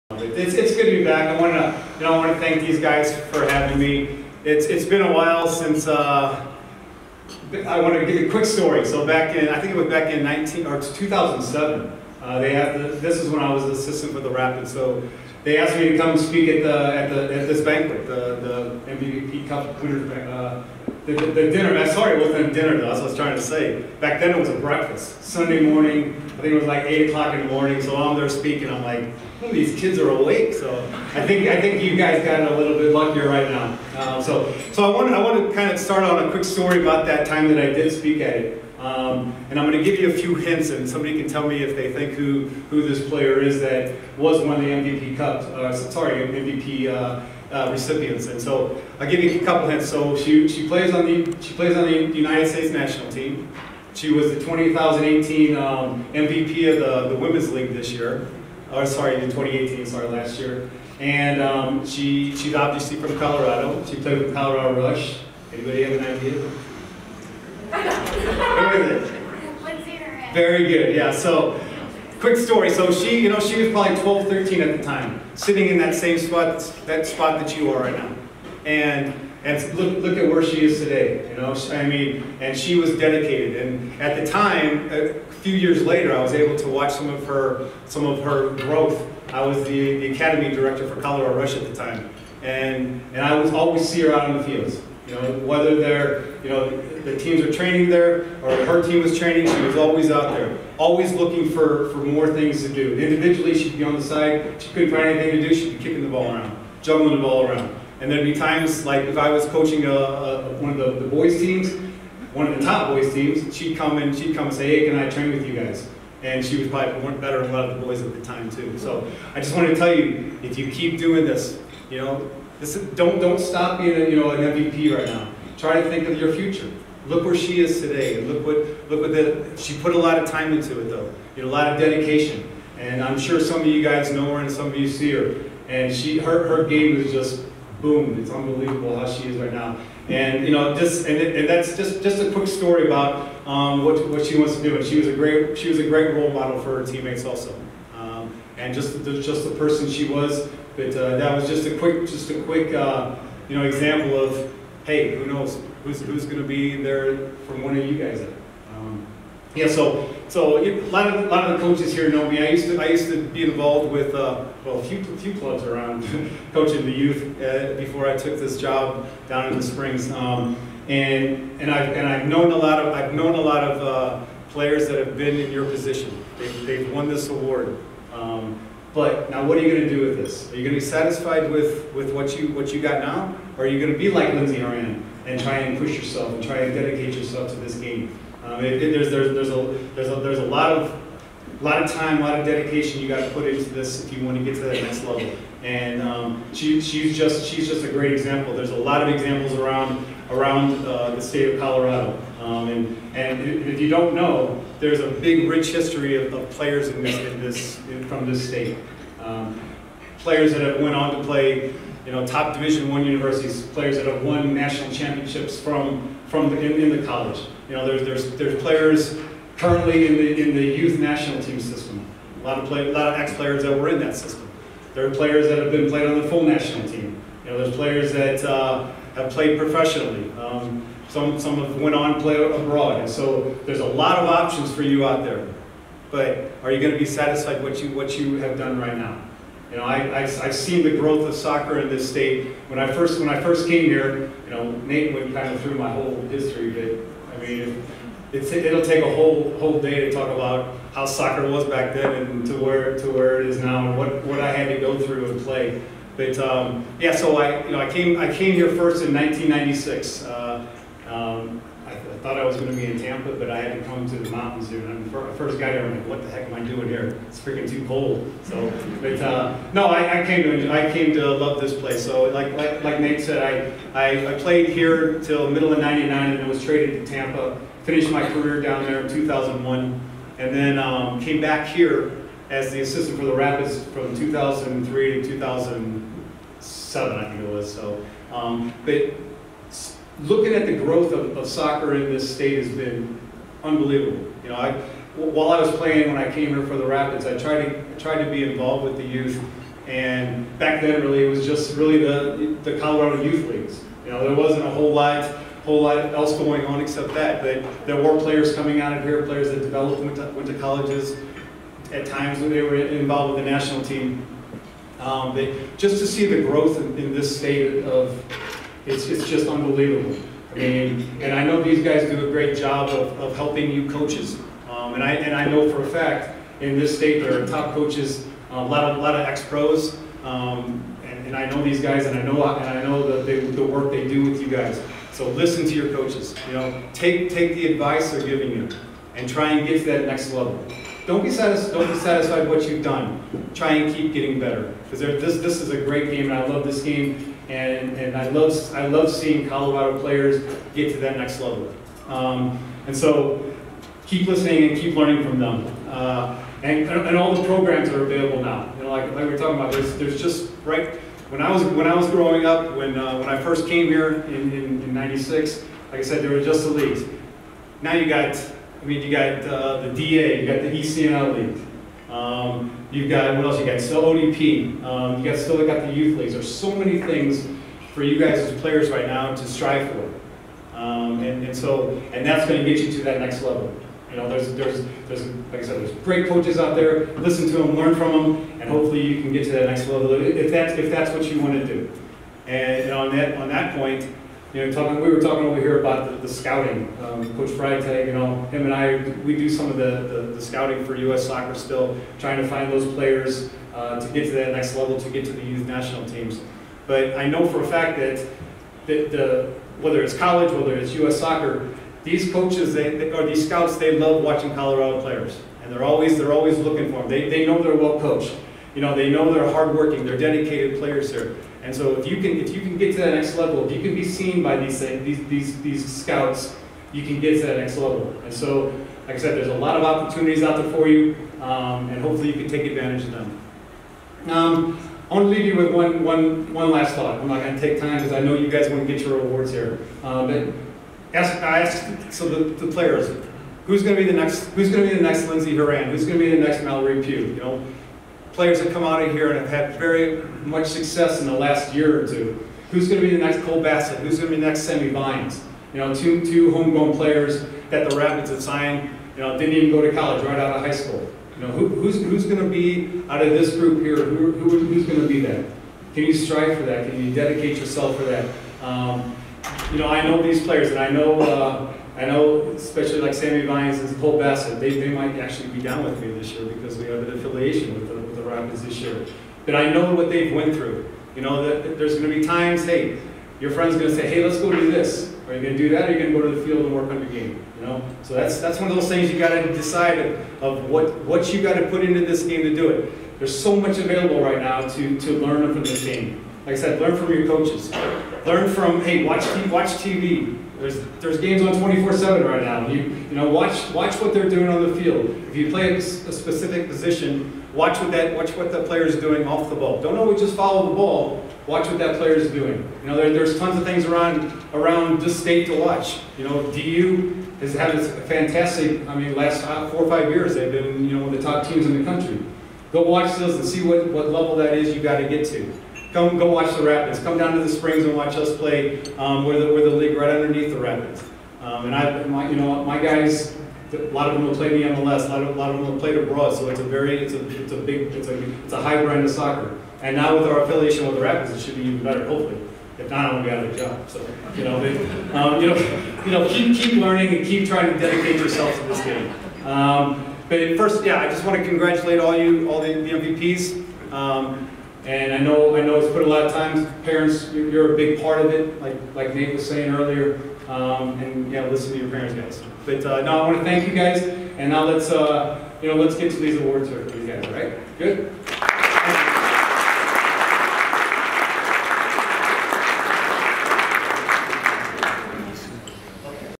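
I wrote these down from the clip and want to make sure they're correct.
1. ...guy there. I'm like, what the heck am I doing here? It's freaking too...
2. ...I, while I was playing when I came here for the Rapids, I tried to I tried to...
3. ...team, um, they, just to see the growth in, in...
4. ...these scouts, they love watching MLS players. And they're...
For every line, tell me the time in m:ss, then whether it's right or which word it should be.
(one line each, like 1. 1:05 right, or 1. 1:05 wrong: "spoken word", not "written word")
1. 4:25 right
2. 4:54 right
3. 5:13 right
4. 6:53 wrong: "Colorado", not "MLS".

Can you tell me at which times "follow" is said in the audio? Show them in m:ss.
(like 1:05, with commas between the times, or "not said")
8:30.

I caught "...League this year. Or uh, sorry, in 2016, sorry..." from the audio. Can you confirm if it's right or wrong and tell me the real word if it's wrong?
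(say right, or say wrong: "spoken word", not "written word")
wrong: "2018", not "2016".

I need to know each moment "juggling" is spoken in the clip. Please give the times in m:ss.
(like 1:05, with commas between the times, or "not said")
1:46.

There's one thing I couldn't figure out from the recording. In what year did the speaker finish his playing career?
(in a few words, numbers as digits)
2001.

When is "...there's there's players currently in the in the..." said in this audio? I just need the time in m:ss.
3:38.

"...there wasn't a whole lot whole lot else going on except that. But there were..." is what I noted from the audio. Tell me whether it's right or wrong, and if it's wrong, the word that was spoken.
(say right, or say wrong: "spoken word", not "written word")
right.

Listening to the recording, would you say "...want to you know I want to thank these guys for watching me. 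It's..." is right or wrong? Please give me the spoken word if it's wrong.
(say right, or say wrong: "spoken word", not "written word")
wrong: "having", not "watching".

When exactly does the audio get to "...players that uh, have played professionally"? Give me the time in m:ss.
3:47.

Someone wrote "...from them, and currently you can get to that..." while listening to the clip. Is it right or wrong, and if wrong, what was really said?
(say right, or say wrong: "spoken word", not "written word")
wrong: "hopefully", not "currently".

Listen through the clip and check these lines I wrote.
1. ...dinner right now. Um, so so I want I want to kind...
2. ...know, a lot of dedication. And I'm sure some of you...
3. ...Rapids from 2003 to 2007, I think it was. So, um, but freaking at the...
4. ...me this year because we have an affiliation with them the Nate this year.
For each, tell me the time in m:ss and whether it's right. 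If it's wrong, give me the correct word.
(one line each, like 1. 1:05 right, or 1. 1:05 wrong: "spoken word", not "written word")
1. 0:32 wrong: "luckier", not "dinner"
2. 2:11 right
3. 4:43 wrong: "looking", not "freaking"
4. 7:56 wrong: "Rapids", not "Nate".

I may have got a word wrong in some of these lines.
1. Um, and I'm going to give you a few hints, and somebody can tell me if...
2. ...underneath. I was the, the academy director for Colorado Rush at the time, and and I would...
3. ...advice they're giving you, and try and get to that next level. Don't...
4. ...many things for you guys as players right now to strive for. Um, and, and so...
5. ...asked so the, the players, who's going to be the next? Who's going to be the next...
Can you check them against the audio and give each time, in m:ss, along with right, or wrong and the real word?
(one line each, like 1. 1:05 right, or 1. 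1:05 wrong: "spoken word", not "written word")
1. 0:38 right
2. 1:28 wrong: "growth", not "underneath"
3. 5:37 right
4. 6:16 right
5. 7:21 right.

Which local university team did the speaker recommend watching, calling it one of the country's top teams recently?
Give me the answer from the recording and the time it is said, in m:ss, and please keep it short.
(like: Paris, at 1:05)
DU, at 8:36.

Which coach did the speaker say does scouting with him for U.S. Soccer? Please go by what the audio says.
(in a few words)
Coach Freitag.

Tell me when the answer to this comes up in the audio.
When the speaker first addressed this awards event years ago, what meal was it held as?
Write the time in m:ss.
0:24.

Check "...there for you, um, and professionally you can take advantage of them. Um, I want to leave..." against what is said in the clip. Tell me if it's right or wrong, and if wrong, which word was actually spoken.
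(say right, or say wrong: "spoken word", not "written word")
wrong: "hopefully", not "professionally".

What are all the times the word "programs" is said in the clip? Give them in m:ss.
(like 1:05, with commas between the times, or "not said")
5:57.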